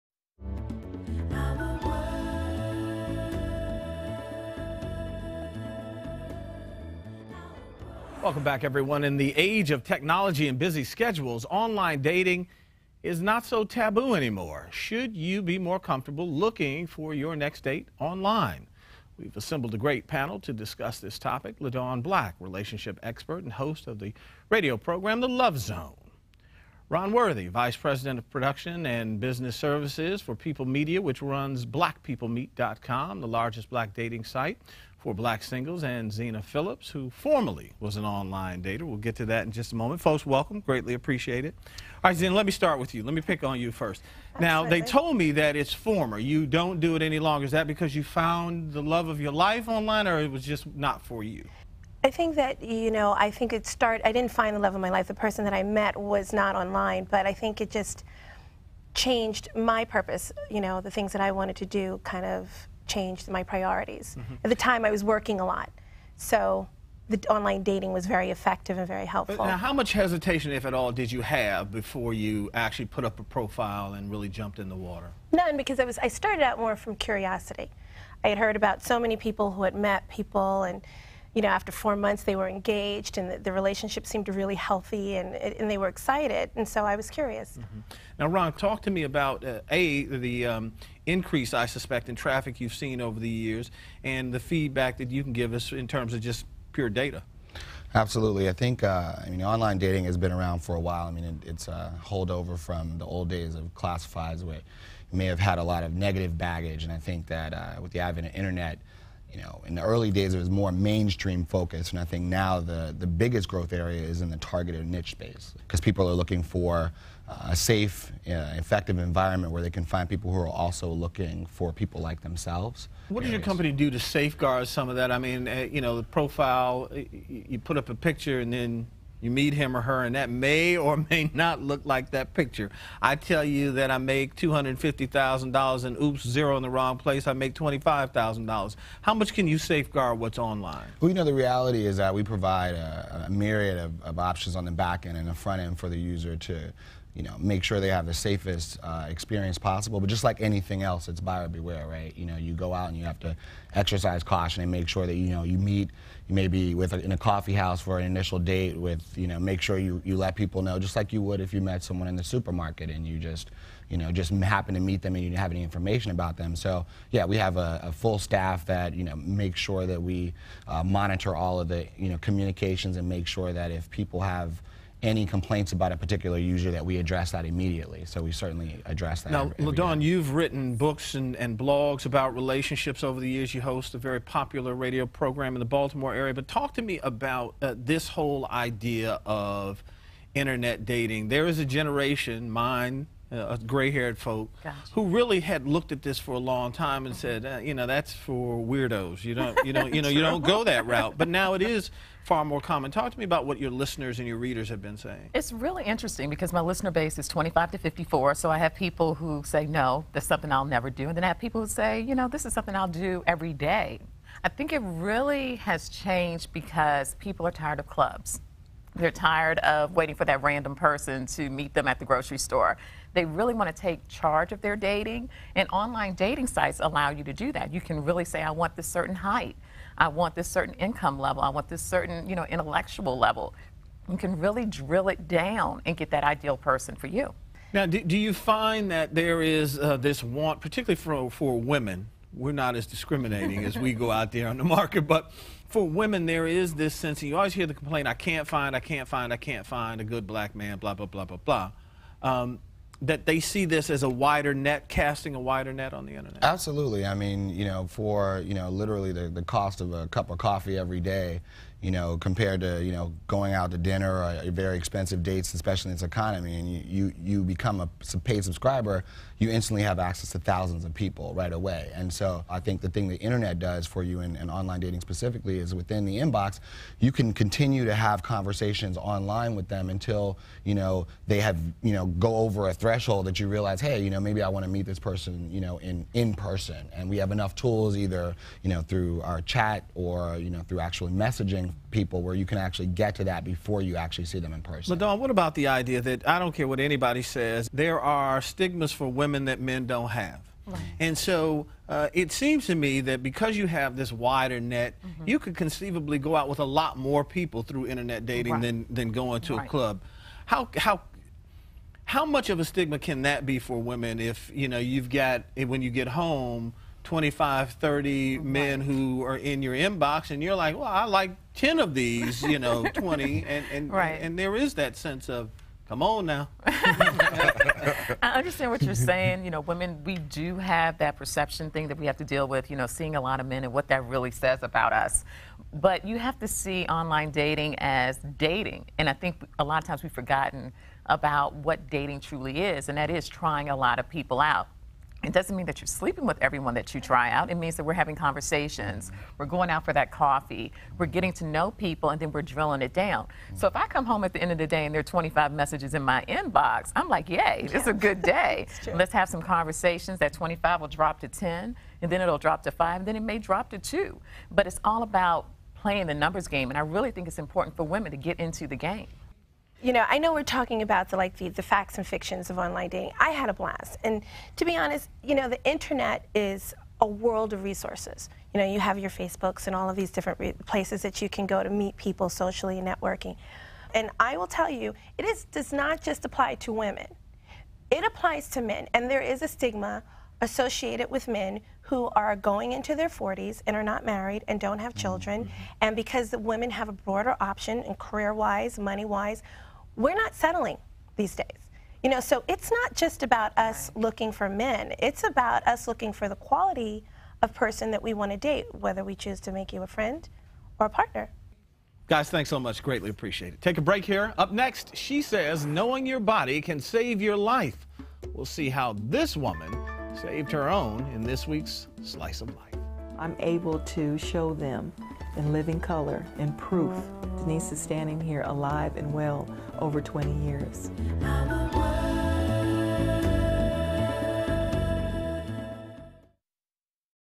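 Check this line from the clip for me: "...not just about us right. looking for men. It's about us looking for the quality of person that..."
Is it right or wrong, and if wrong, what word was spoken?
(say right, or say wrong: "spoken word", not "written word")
right.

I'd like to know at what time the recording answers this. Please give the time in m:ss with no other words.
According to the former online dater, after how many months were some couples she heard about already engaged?
1:21.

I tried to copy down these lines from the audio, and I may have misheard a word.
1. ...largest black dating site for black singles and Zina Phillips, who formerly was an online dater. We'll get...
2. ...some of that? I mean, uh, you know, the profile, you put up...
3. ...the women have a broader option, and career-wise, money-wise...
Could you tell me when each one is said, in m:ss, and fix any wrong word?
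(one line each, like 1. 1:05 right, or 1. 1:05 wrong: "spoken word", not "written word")
1. 0:33 right
2. 2:04 right
3. 6:36 right.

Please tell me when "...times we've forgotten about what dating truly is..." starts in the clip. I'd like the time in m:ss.
5:39.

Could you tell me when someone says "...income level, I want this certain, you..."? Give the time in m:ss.
3:50.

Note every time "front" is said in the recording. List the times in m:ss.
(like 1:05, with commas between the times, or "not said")
2:25.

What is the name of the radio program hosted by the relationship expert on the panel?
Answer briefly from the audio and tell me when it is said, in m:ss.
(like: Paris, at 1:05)
The Love Zone, at 0:25.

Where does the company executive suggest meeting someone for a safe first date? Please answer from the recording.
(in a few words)
coffee house.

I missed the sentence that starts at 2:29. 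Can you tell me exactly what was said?
But just like anything else, it's buyer beware, right?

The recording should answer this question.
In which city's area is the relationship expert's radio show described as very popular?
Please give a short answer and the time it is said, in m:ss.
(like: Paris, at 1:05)
Baltimore, at 3:05.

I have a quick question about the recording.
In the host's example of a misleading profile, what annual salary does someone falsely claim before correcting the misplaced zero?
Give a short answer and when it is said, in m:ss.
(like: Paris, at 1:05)
$250,000, at 2:14.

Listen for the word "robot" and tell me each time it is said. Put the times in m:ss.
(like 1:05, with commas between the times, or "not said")
not said.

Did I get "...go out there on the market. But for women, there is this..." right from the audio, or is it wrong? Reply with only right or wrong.
right.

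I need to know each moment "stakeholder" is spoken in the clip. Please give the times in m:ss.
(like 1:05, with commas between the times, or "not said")
not said.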